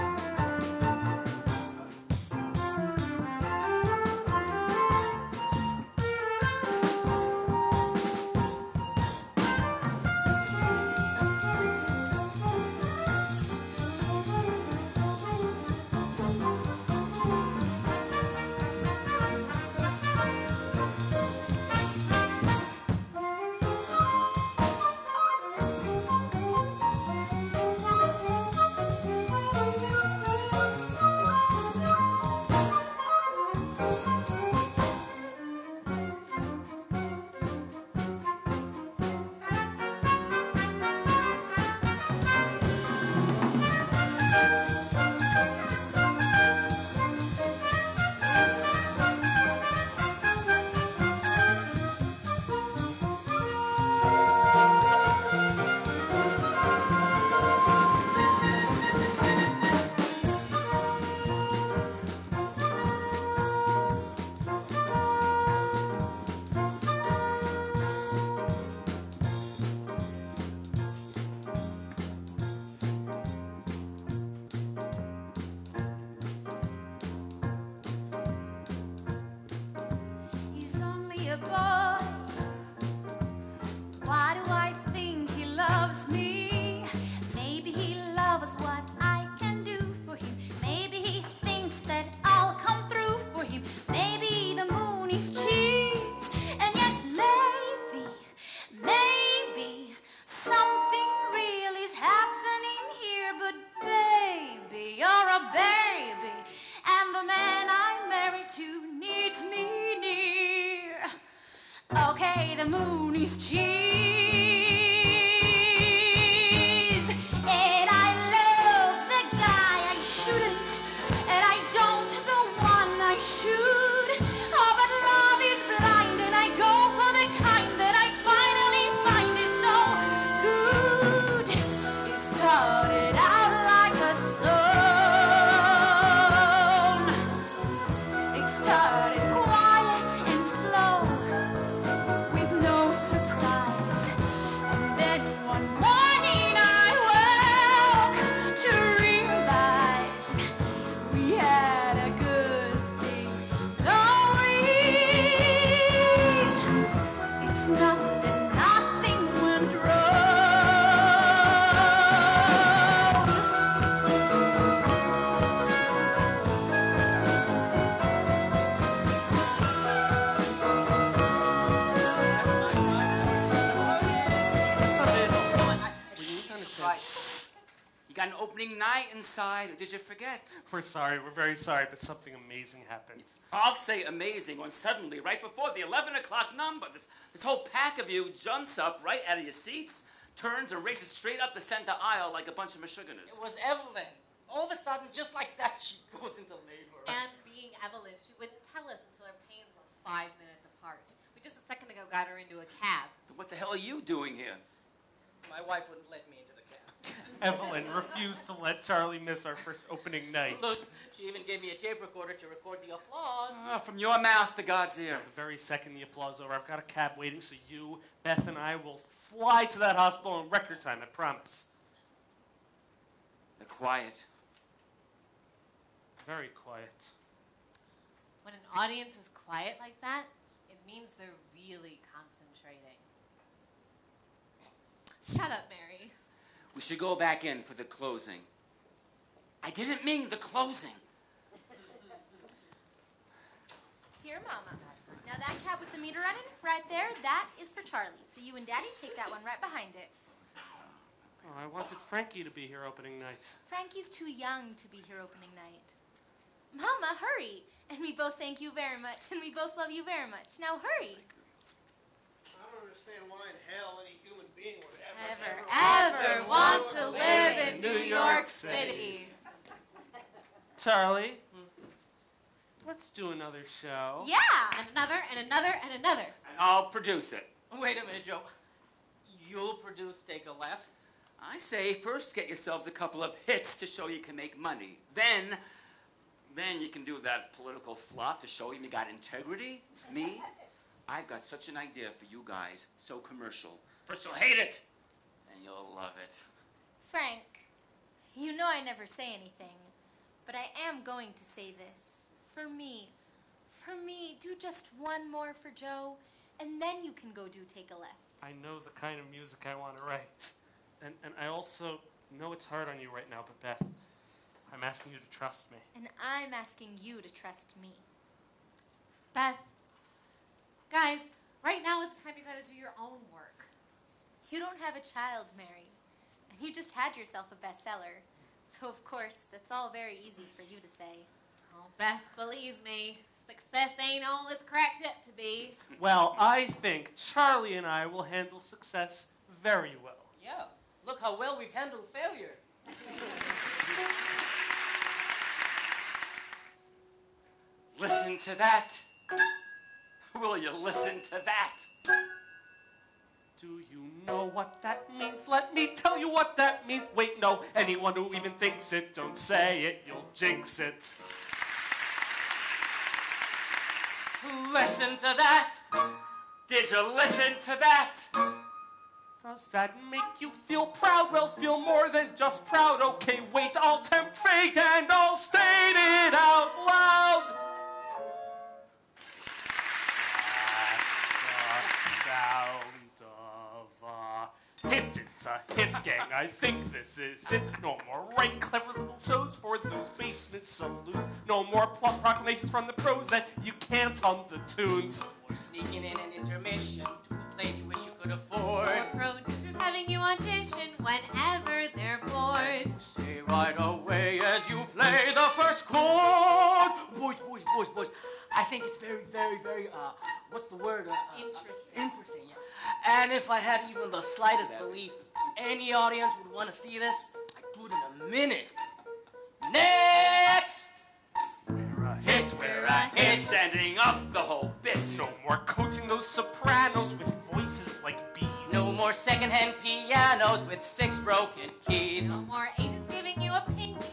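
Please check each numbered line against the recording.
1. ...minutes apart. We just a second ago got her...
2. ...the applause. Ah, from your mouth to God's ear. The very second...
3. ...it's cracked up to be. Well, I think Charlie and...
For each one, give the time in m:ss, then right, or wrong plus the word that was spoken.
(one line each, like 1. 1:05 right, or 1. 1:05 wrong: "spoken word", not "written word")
1. 3:20 right
2. 3:32 right
3. 5:34 right.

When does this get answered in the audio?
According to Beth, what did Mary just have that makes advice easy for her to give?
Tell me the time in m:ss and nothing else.
5:27.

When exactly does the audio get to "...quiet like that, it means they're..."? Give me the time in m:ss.
3:49.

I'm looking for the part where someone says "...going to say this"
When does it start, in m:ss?
5:01.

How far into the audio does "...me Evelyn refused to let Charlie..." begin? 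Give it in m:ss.
3:26.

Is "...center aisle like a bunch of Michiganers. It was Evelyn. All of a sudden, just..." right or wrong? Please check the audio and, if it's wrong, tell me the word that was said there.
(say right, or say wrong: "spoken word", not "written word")
right.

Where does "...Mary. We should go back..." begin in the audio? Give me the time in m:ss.
3:55.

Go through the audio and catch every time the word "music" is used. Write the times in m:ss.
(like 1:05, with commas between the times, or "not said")
5:09.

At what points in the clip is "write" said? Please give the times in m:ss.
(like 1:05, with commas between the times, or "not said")
5:10.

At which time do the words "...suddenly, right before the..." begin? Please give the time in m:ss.
3:04.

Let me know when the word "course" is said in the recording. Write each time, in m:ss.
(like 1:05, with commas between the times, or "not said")
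5:29.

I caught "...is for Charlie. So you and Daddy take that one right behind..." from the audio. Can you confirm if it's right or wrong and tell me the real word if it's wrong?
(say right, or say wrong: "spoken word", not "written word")
right.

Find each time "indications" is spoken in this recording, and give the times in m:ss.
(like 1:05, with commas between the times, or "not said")
not said.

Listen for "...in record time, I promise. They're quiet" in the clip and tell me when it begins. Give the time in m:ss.
3:40.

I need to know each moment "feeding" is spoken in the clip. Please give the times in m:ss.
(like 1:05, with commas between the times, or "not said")
not said.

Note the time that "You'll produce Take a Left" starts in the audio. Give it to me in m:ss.
4:39.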